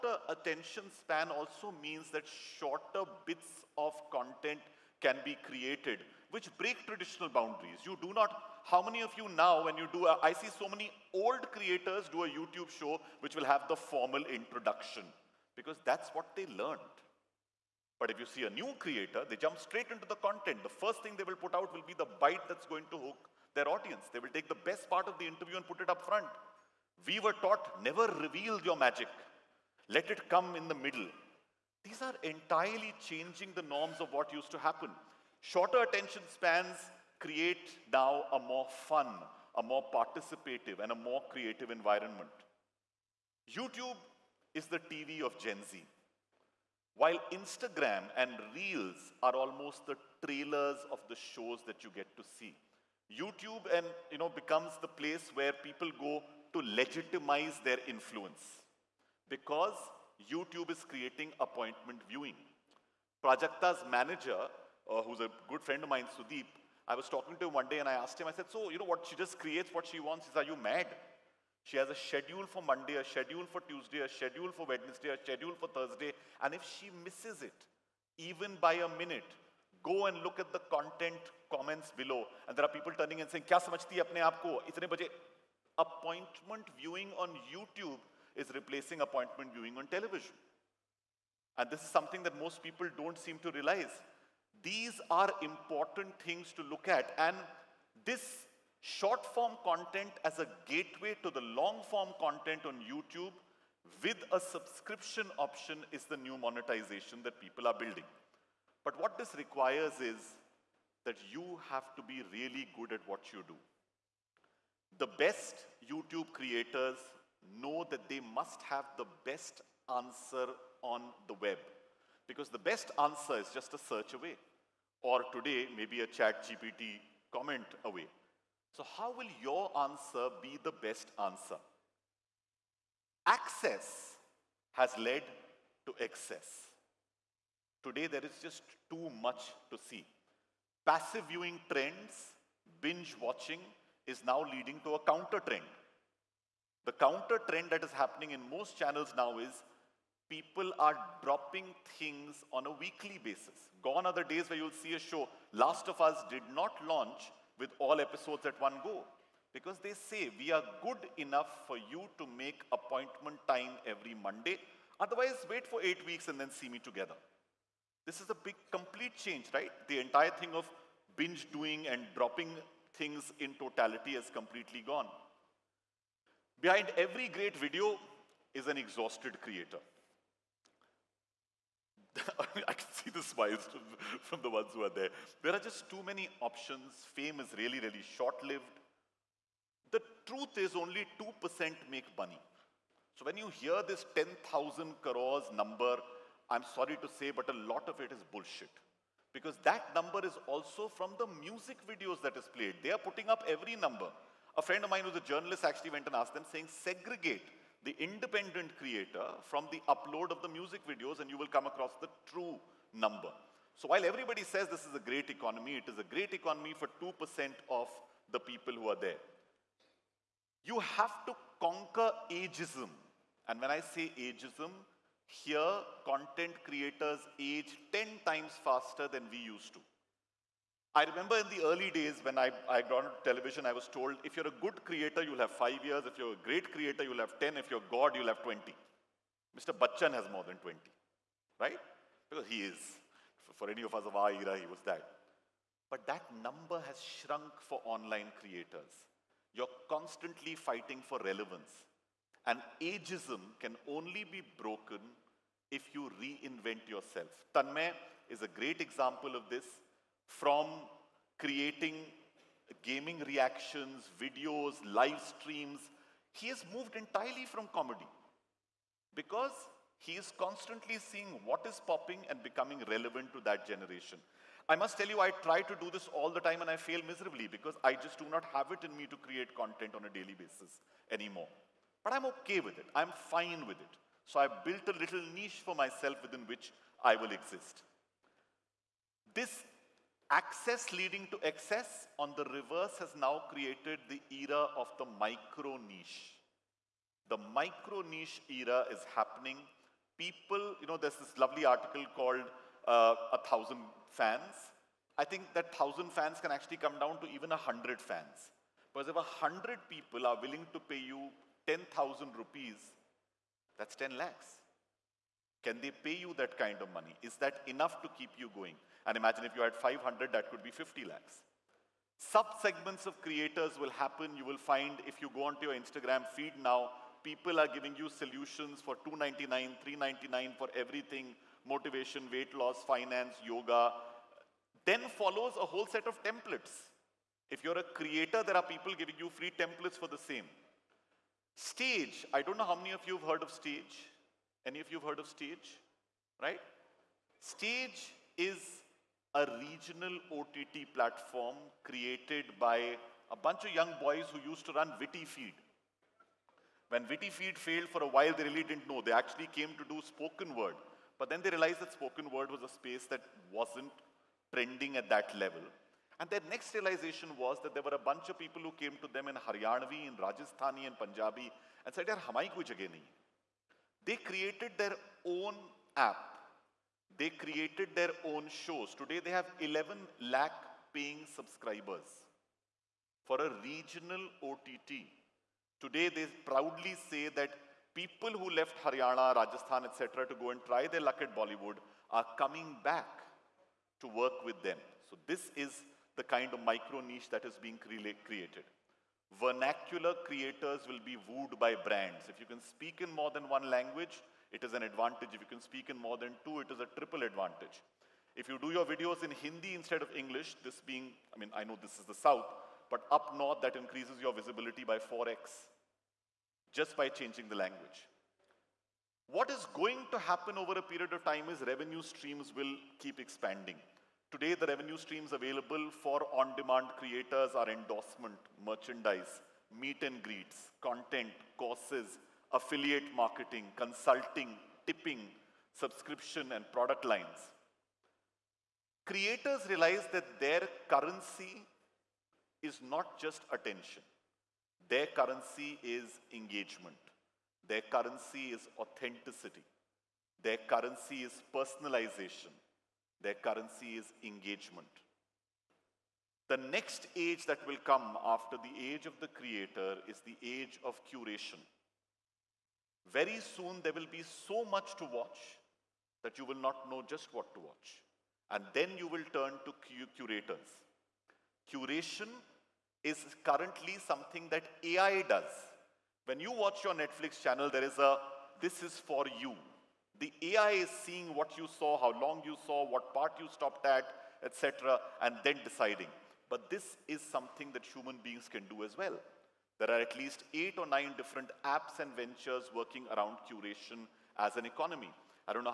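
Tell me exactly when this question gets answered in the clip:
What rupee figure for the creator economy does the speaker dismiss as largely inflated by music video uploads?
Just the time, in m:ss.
3:14.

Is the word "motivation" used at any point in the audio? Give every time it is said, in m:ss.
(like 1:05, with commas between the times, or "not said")
5:31.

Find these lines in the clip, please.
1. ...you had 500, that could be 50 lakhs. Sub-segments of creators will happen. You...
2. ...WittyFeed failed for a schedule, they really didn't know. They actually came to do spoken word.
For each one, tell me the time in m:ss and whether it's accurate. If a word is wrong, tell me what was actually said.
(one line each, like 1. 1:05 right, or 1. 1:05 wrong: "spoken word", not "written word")
1. 5:19 right
2. 5:57 wrong: "while", not "schedule".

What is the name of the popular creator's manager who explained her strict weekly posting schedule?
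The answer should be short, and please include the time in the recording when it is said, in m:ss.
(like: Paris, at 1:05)
Sudeep, at 1:06.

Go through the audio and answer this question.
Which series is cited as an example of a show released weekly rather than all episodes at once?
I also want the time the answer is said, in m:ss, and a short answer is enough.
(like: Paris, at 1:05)
Last of Us, at 2:35.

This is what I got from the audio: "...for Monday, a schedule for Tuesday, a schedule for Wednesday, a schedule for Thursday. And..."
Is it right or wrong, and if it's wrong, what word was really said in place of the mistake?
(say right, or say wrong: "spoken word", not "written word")
right.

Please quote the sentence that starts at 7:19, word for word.
Creators realize that their currency is not just attention.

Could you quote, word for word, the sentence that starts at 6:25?
Today they proudly say that people who left Haryana, Rajasthan, etc.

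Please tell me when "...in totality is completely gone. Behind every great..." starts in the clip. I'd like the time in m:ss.
2:53.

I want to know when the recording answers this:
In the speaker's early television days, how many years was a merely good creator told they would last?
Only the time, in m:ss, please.
3:55.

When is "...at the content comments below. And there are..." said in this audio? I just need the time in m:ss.
1:20.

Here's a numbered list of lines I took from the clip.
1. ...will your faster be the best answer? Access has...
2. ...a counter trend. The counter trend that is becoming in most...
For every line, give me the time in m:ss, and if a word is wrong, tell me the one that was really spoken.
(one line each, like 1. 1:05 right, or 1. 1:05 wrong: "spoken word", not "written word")
1. 2:09 wrong: "answer", not "faster"
2. 2:24 wrong: "happening", not "becoming".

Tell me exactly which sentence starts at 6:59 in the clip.
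What is going to happen over a period of time is revenue streams will keep expanding.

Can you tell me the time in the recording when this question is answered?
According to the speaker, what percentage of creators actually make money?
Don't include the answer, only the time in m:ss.
3:10.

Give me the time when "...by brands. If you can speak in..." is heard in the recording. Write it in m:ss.
6:41.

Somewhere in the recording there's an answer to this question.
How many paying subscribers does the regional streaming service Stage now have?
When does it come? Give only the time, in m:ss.
6:19.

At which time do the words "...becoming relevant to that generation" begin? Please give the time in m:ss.
4:32.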